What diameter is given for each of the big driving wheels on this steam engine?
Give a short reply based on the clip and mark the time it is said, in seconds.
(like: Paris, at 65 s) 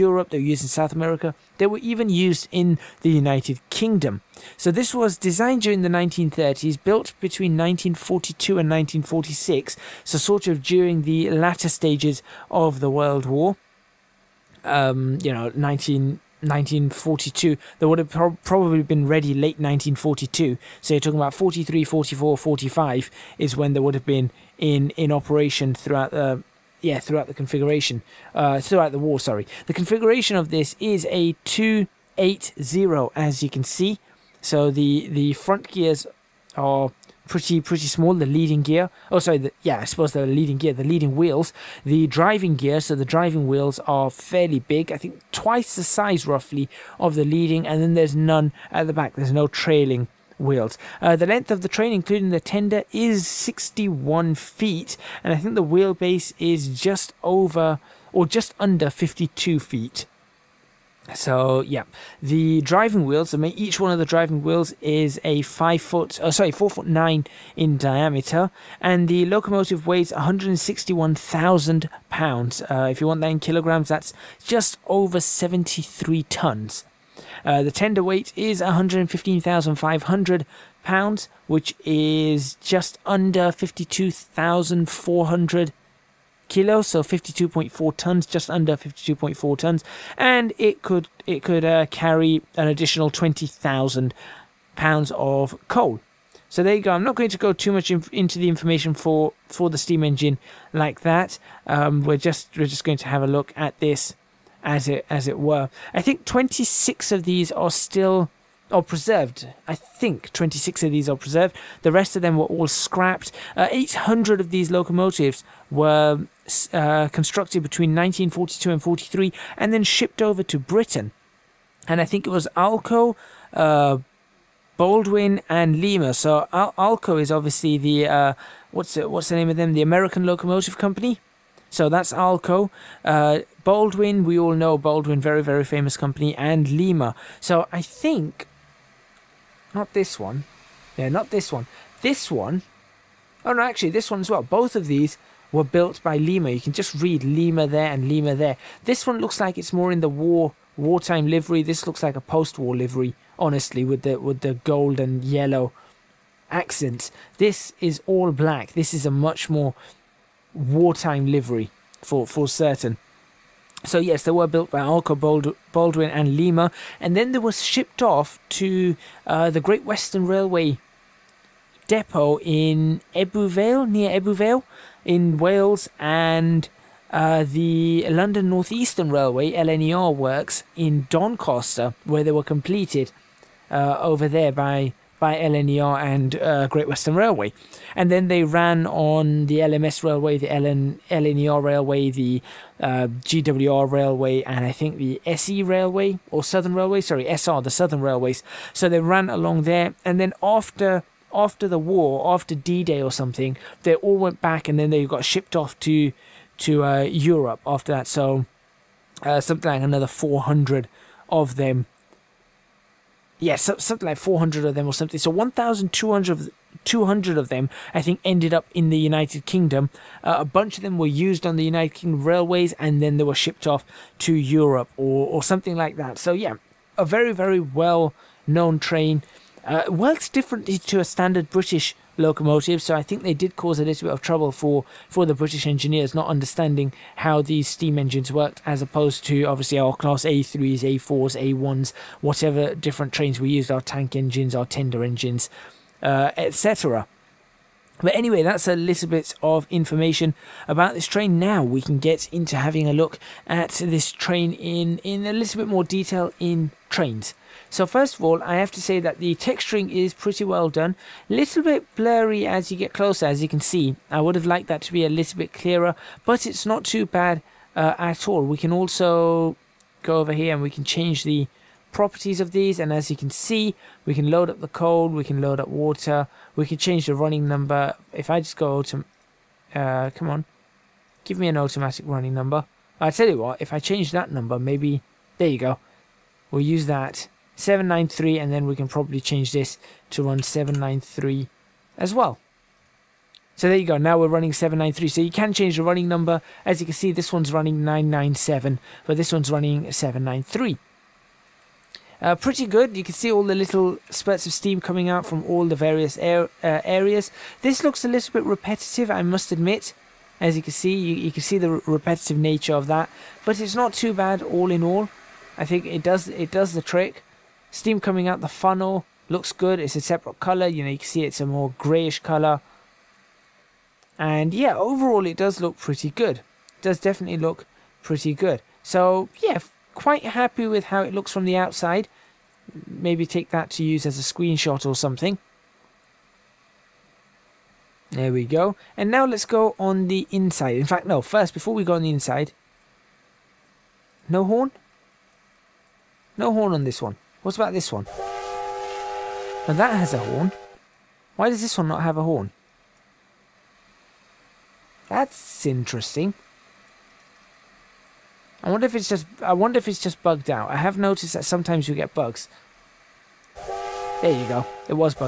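4 foot 9, at 66 s.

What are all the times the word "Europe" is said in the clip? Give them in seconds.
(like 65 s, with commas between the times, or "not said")
207 s, 224 s.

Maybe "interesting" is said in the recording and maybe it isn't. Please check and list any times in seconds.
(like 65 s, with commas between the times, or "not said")
355 s.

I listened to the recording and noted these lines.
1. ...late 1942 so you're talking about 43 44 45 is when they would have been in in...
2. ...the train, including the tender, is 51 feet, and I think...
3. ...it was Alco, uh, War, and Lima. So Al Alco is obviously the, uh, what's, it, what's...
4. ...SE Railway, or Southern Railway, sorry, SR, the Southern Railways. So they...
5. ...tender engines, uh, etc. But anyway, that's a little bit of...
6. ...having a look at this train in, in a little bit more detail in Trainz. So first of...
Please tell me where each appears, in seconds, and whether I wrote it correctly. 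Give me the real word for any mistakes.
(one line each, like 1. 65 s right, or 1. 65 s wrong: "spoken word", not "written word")
1. 19 s right
2. 51 s wrong: "61", not "51"
3. 122 s wrong: "Baldwin", not "War"
4. 195 s right
5. 244 s right
6. 252 s right.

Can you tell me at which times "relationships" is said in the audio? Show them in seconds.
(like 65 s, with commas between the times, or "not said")
not said.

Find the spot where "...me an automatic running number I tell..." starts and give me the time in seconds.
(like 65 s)
281 s.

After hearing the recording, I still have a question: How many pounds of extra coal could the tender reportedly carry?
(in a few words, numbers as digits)
20,000 pounds.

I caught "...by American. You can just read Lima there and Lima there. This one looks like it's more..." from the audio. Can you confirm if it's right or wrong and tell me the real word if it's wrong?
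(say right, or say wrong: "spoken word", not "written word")
wrong: "Lima", not "American".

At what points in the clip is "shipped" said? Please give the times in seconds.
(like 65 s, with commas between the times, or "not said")
119 s, 167 s, 205 s, 223 s.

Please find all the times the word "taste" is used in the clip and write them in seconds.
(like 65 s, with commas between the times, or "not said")
not said.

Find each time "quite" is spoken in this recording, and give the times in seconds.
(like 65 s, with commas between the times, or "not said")
329 s.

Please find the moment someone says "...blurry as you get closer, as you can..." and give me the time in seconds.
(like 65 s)
261 s.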